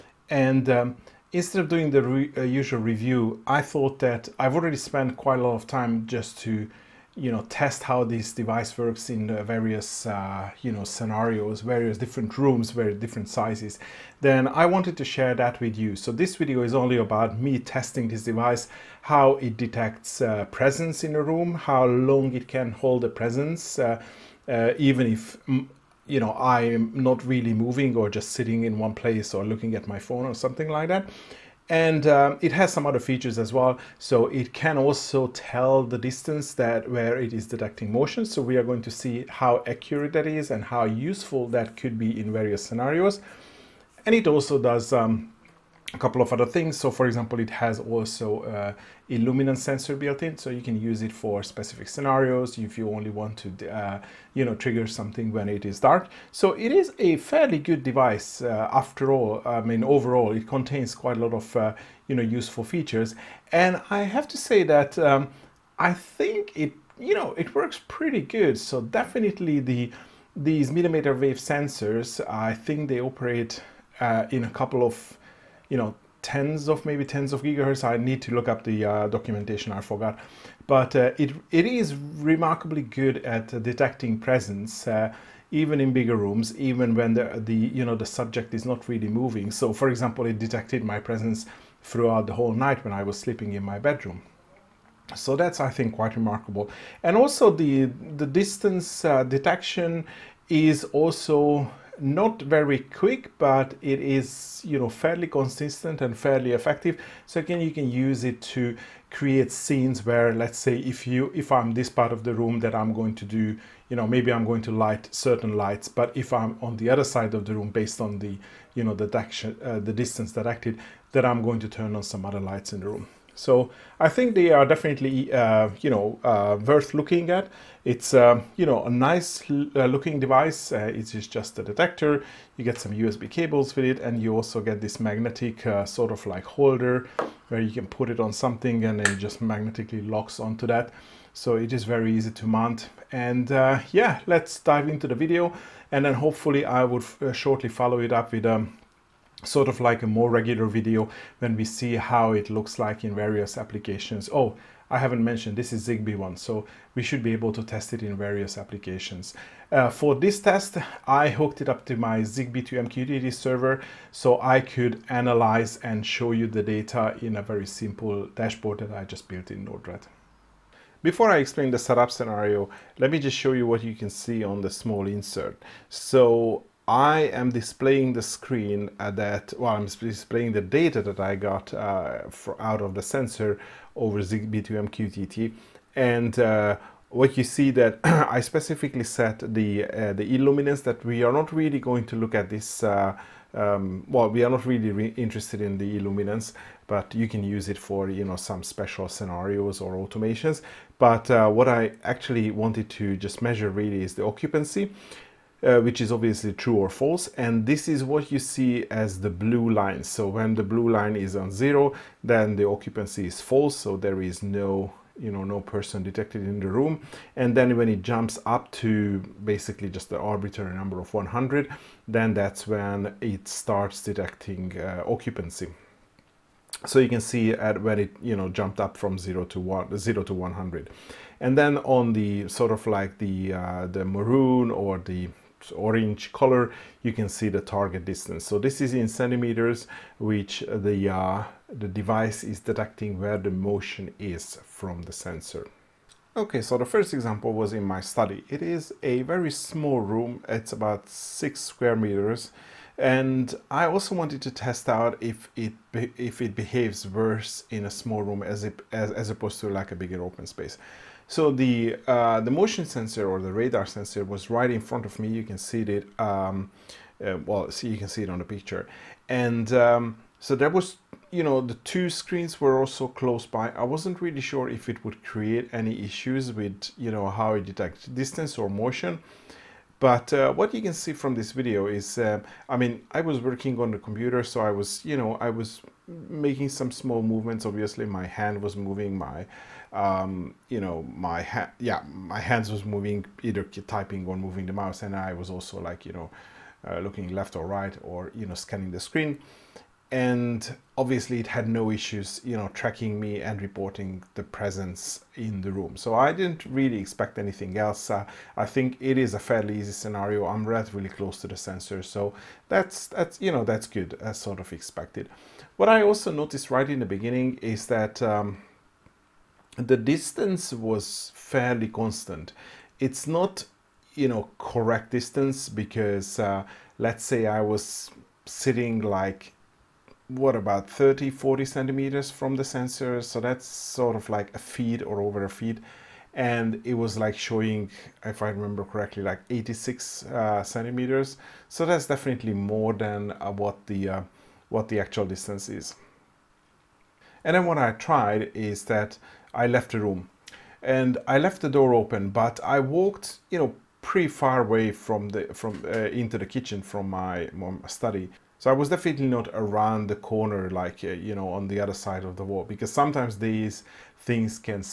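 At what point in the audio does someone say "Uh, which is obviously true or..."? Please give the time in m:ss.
3:25.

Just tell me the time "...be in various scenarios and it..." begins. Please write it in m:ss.
0:41.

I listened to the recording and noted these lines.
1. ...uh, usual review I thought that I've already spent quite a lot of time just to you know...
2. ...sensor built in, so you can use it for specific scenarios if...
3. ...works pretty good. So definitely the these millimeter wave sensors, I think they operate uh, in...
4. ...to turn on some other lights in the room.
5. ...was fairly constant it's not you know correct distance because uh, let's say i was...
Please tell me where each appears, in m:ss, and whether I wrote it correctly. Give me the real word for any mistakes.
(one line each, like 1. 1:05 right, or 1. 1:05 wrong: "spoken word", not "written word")
1. 0:02 right
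2. 0:49 right
3. 1:07 right
4. 2:01 right
5. 5:20 right.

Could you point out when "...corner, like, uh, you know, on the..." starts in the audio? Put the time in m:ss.
6:00.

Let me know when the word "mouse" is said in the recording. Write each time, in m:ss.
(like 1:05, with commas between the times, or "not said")
4:54.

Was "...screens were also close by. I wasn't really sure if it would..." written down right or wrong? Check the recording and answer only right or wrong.
right.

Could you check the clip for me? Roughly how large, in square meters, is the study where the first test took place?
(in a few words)
6 square meters.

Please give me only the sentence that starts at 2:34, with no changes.
Oh, I haven't mentioned this is Zigbee one, so we should be able to test it in various applications.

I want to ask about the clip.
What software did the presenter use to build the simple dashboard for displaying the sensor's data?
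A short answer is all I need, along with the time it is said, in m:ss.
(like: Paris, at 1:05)
Node-RED, at 2:49.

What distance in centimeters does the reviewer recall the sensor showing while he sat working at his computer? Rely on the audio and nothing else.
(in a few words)
86 centimeters.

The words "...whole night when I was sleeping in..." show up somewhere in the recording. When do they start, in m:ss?
1:32.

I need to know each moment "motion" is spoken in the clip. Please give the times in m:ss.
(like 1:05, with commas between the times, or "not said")
0:37, 4:03, 4:22, 4:38.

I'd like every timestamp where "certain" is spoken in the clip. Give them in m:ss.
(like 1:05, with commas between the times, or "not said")
1:55.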